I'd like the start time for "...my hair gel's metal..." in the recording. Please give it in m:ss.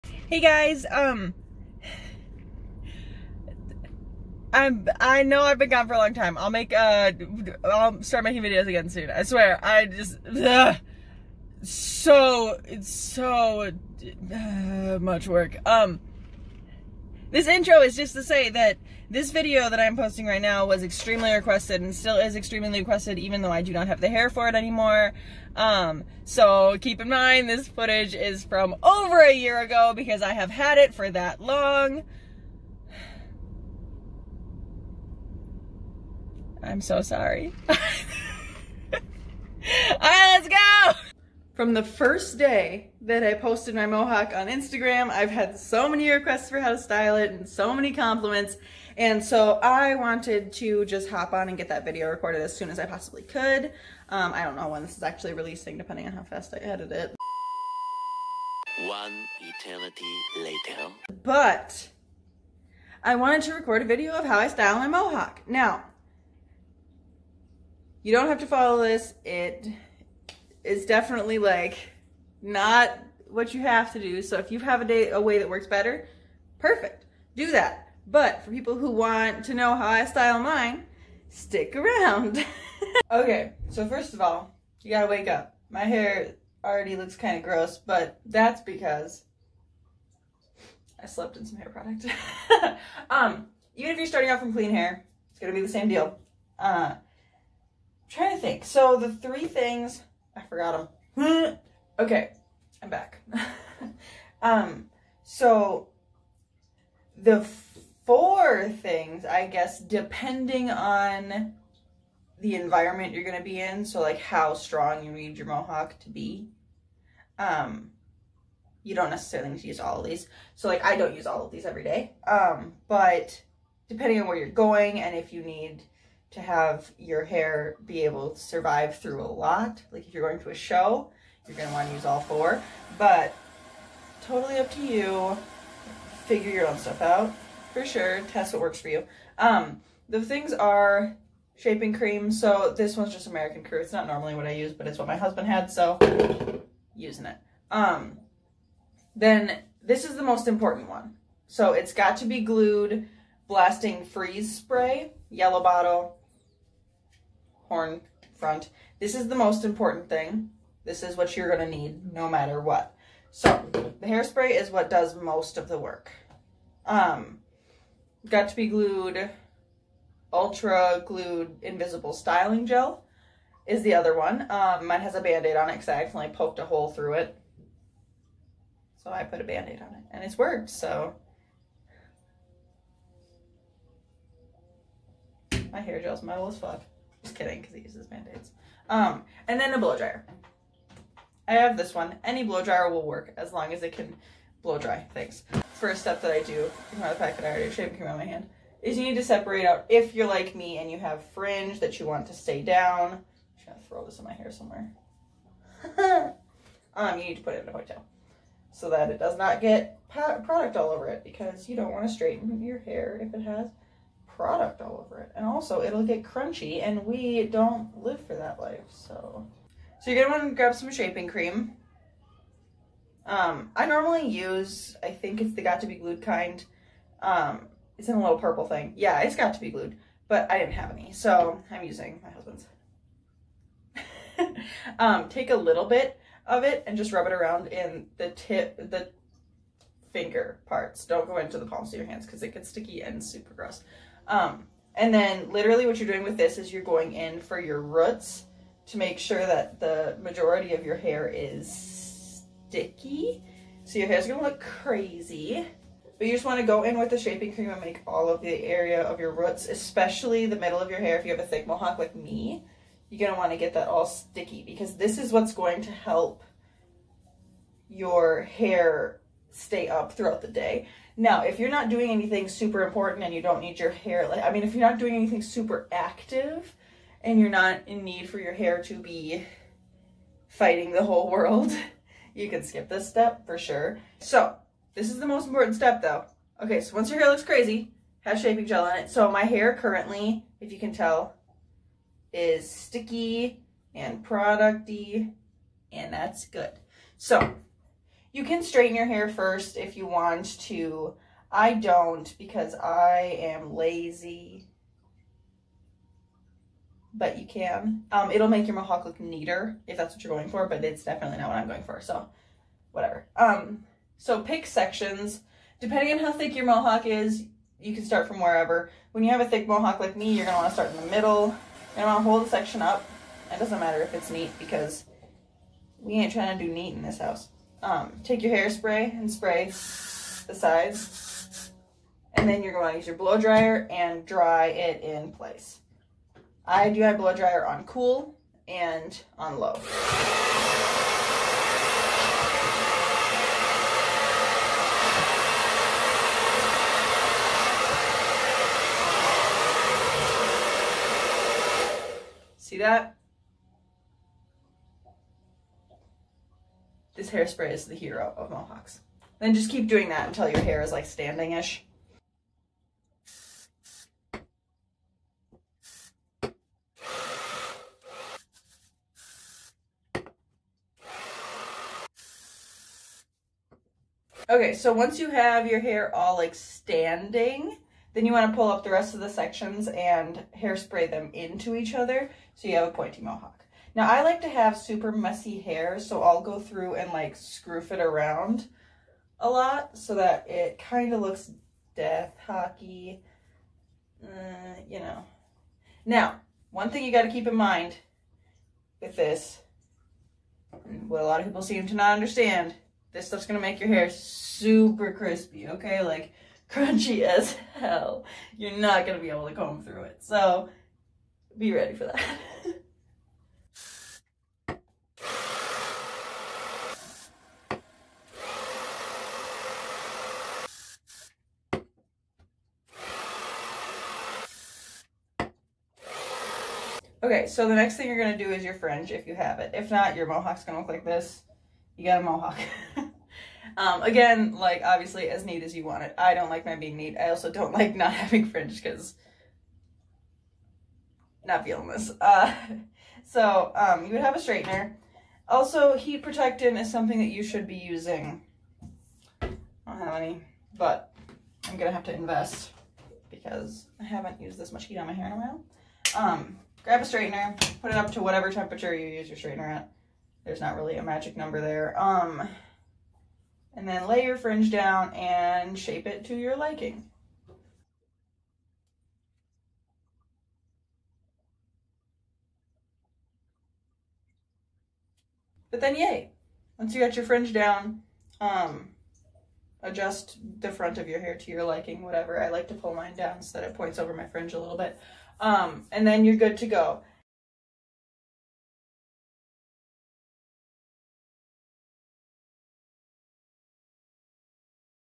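3:05.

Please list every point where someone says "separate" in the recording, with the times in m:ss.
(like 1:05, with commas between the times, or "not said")
3:19.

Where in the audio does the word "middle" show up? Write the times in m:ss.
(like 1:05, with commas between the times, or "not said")
4:20, 5:21.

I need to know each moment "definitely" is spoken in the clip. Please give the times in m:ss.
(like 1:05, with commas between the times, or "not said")
1:10, 5:11.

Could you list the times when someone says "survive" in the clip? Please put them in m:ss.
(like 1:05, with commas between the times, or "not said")
2:08.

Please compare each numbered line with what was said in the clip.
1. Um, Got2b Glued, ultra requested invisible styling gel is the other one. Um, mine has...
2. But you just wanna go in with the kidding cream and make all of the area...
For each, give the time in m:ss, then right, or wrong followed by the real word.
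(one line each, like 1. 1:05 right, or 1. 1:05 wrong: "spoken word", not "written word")
1. 2:46 wrong: "glued", not "requested"
2. 4:16 wrong: "shaping", not "kidding".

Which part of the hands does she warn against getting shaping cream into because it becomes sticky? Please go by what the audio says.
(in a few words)
The palms.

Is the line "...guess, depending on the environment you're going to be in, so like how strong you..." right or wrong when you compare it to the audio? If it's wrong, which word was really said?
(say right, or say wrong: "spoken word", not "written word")
right.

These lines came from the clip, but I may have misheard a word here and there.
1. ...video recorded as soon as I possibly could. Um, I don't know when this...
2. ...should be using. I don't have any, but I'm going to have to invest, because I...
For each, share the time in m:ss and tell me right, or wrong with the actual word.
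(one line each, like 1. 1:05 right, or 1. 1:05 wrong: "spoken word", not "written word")
1. 0:51 right
2. 7:27 right.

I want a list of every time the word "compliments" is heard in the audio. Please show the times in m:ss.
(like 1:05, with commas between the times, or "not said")
0:47.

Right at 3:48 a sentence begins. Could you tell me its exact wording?
Yeah, it's Got2b Glued, but I didn't have any, so I'm using my husband's.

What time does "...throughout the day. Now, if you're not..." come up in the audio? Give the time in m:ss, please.
4:30.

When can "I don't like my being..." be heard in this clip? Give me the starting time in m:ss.
7:16.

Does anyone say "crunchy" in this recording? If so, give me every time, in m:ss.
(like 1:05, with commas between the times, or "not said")
3:36, 6:46.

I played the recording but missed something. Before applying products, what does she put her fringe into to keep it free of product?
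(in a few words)
A ponytail.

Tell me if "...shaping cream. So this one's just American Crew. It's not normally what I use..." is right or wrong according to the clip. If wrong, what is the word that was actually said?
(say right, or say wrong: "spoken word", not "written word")
right.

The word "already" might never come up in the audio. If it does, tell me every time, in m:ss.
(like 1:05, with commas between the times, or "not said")
1:26, 3:17.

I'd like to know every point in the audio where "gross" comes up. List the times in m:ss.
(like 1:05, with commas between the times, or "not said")
1:27, 4:03.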